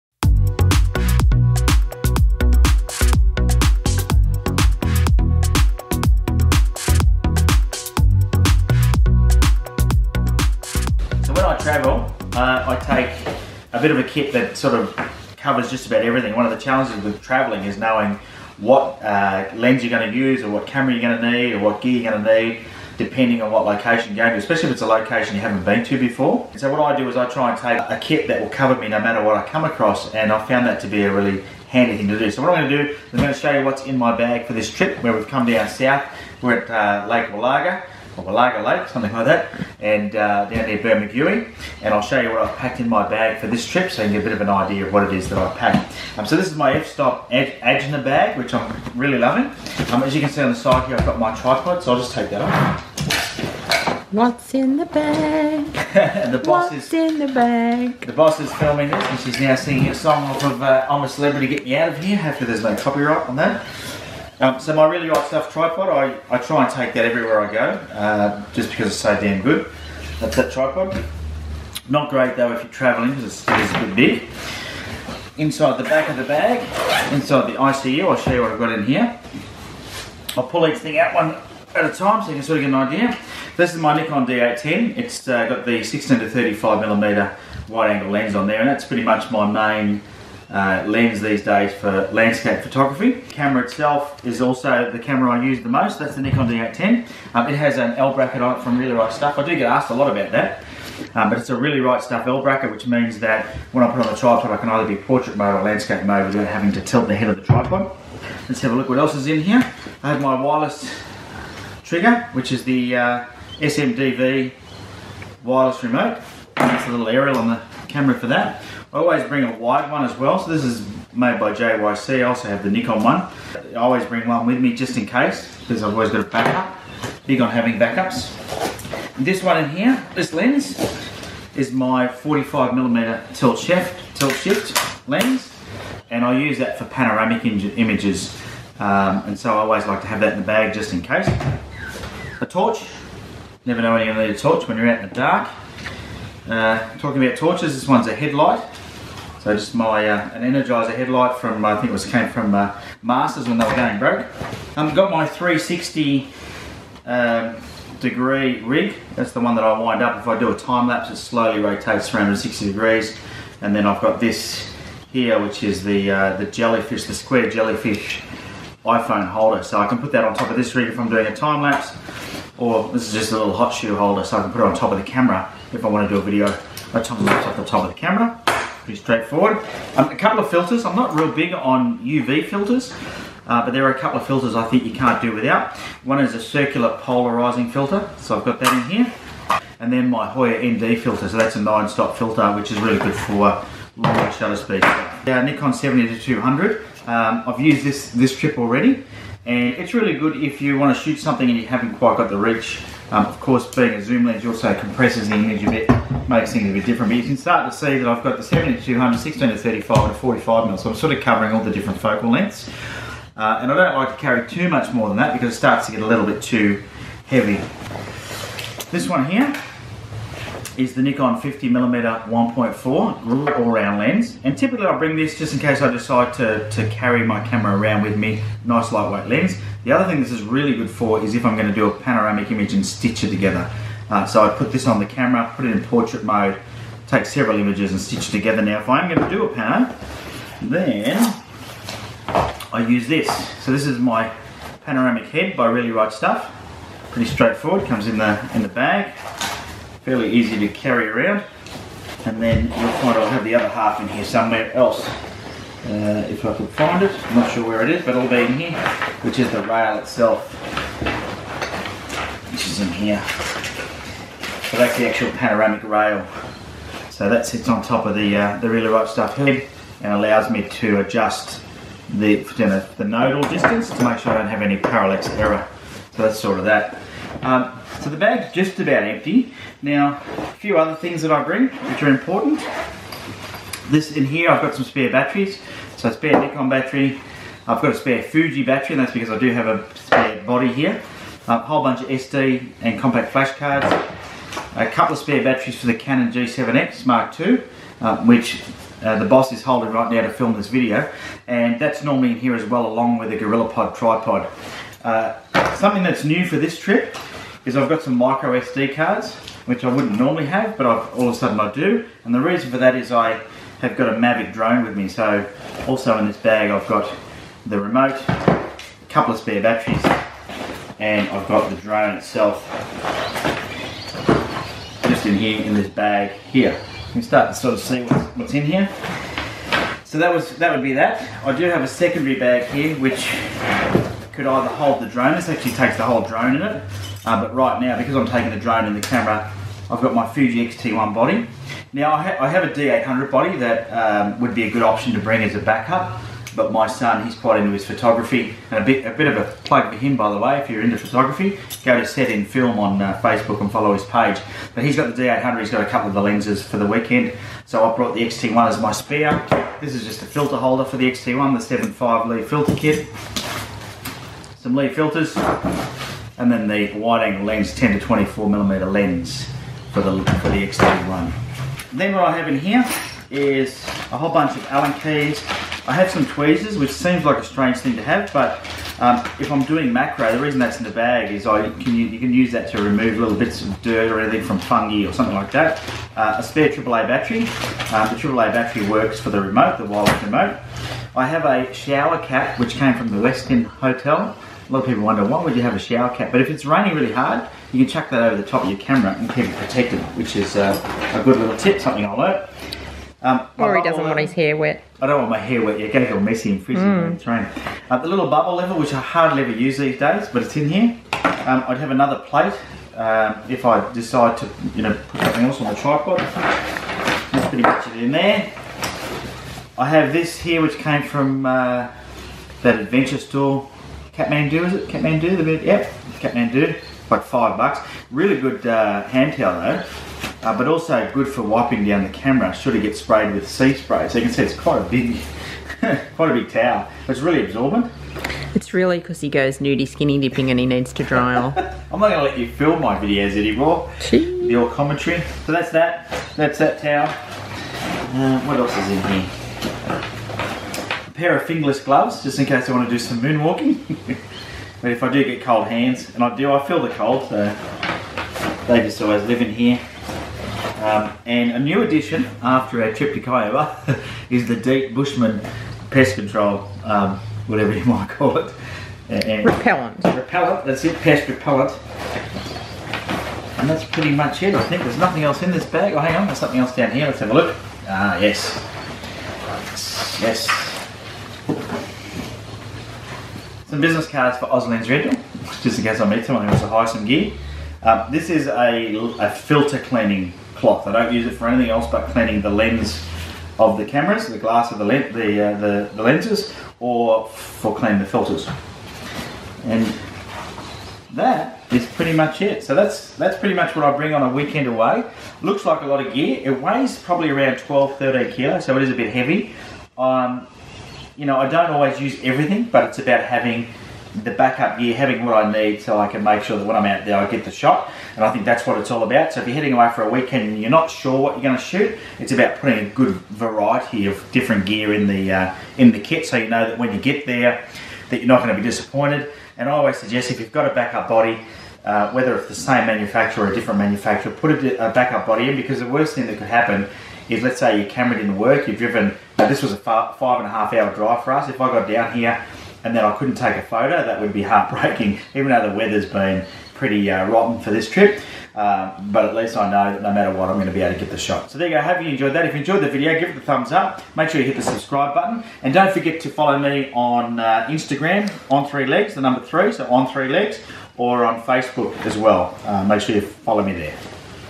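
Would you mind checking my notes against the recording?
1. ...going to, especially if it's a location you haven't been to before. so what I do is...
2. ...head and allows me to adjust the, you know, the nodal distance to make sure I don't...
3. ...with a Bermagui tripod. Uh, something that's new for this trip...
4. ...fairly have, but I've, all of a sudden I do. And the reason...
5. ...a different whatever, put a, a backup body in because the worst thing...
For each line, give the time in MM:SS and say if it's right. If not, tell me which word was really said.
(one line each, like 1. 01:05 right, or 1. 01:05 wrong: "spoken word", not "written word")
1. 00:24 right
2. 04:29 right
3. 05:03 wrong: "GorillaPod", not "Bermagui"
4. 05:10 wrong: "normally", not "fairly"
5. 08:53 wrong: "manufacturer", not "whatever".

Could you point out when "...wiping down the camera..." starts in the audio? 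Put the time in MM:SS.
07:11.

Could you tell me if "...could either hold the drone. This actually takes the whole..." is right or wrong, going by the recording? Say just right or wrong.
right.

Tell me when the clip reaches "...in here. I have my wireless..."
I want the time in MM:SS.
01:49.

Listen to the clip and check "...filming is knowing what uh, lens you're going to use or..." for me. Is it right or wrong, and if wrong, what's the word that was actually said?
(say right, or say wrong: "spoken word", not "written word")
wrong: "traveling", not "filming".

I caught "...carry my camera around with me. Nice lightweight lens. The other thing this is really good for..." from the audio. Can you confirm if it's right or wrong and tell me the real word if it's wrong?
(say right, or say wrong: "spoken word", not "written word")
right.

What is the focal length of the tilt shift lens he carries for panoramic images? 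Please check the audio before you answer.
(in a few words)
45mm.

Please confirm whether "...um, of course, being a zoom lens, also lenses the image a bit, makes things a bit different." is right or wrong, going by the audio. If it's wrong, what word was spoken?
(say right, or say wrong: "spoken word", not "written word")
wrong: "compresses", not "lenses".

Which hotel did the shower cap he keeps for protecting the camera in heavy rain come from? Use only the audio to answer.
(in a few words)
Westin.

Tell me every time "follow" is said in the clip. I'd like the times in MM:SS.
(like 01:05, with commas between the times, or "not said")
05:53, 09:16, 09:23.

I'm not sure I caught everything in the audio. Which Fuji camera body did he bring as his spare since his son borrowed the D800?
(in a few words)
Fuji X-T1.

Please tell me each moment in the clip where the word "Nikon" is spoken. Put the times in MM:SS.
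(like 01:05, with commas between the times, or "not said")
01:23, 01:36, 02:02, 03:15, 03:41, 04:46.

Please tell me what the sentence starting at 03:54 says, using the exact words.
Uh, so I put this on the camera, put it in portrait mode, take several images and stitch together.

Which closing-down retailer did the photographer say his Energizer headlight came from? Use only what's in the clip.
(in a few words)
Masters.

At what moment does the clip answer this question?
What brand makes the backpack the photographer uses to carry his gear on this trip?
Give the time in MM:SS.
00:46.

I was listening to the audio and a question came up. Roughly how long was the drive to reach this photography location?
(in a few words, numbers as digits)
5.5 hours.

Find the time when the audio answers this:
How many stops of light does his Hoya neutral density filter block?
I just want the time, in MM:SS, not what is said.
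03:11.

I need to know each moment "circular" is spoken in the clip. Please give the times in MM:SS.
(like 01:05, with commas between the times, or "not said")
03:06.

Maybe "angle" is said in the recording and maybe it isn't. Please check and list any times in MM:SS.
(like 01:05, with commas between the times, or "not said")
01:27, 06:06.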